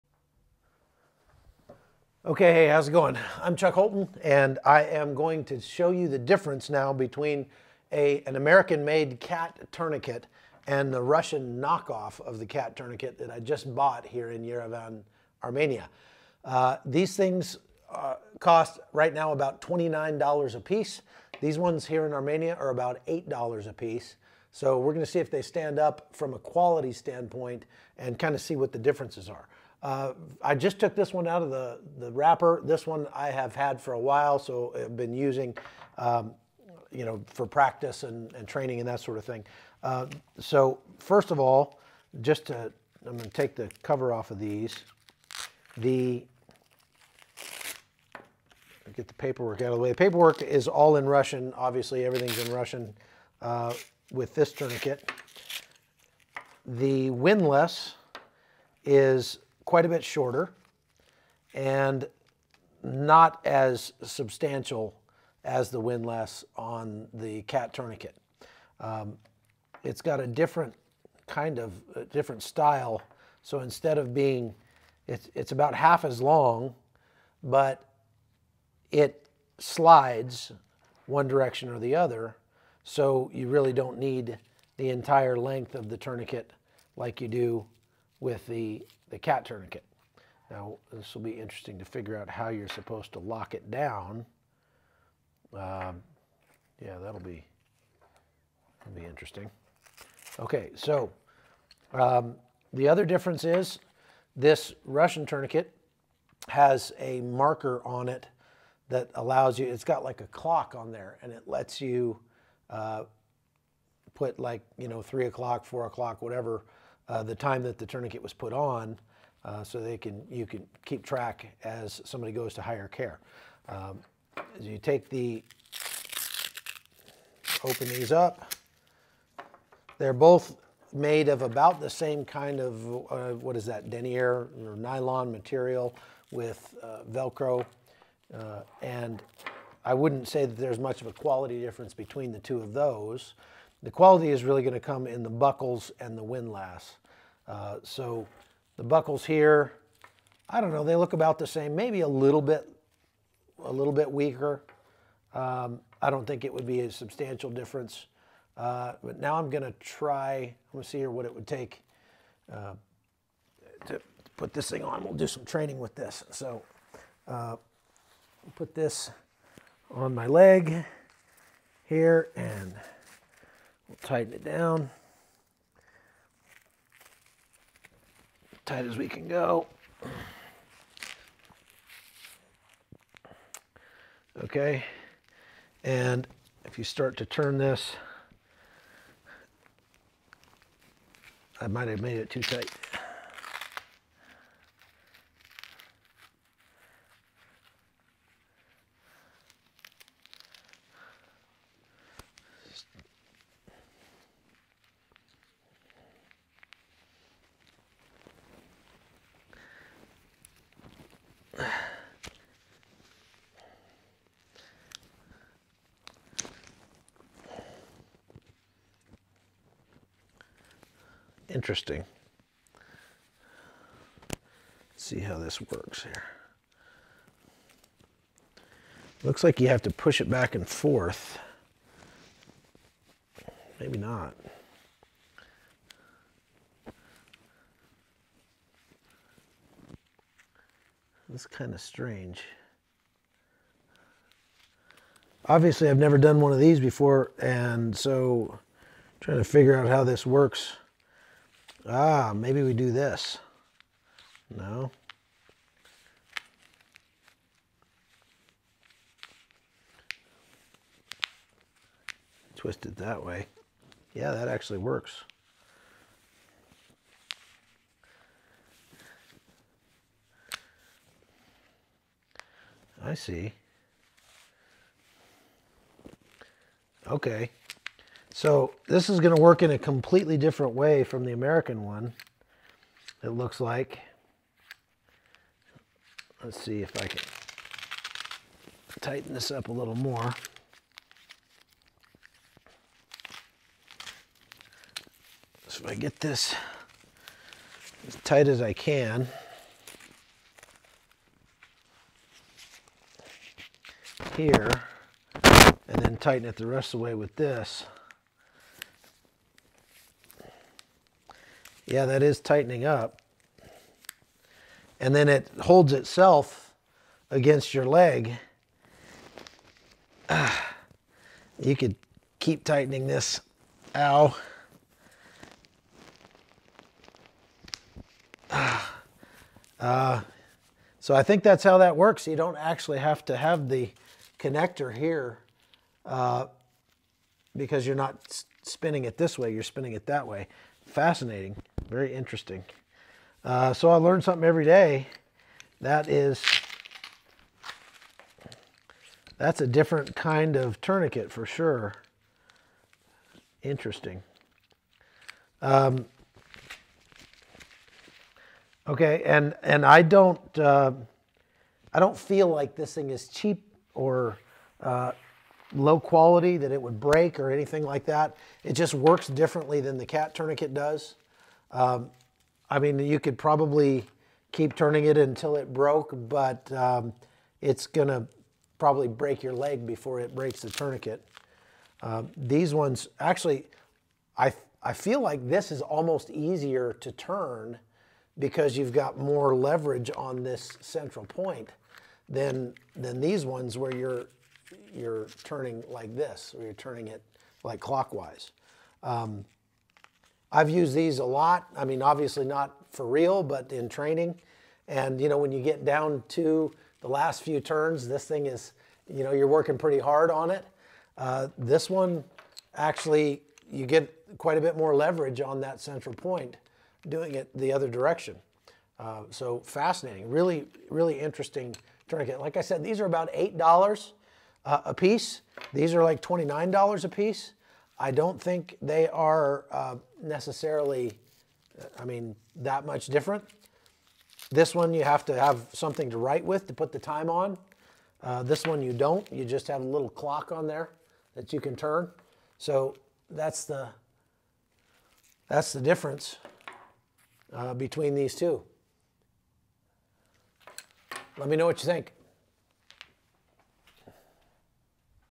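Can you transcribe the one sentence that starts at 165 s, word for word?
We'll do some training with this.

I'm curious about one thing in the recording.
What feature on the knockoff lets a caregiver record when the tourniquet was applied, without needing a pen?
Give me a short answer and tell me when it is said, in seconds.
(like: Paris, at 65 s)
a clock, at 110 s.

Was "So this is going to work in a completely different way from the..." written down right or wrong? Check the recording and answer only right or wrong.
right.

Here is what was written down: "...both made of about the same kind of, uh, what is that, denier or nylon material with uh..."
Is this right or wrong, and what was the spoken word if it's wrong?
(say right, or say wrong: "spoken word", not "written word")
right.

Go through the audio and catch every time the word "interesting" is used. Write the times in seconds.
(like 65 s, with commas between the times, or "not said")
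91 s, 99 s, 221 s, 342 s, 353 s, 421 s.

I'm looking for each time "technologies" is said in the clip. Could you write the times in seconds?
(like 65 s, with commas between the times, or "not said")
not said.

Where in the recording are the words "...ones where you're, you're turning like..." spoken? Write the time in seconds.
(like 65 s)
393 s.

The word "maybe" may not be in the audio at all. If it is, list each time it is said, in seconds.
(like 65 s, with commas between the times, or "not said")
151 s, 233 s, 252 s.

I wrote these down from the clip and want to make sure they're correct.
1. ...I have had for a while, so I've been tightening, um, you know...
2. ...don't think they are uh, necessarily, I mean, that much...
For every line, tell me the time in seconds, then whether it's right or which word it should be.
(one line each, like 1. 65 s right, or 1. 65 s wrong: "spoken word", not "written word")
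1. 33 s wrong: "using", not "tightening"
2. 428 s right.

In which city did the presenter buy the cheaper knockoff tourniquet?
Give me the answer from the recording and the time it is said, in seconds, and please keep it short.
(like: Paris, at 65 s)
Yerevan, at 14 s.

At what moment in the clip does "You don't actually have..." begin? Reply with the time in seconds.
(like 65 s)
332 s.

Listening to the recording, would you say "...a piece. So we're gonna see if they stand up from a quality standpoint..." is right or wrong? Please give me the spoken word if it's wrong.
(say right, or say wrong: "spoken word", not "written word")
right.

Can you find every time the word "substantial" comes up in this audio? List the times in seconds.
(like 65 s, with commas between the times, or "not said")
64 s, 156 s.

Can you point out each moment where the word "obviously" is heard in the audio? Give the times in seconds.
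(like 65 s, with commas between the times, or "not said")
51 s, 245 s, 402 s.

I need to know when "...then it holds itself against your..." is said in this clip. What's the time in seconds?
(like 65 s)
315 s.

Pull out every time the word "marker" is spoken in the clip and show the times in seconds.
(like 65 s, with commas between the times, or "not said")
107 s.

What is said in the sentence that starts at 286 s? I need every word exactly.
Let's see if I can tighten this up a little more.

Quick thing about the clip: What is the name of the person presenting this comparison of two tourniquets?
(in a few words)
Chuck Holton.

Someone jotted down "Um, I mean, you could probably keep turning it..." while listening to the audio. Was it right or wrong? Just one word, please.
right.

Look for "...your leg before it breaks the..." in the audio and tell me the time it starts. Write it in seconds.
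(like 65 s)
379 s.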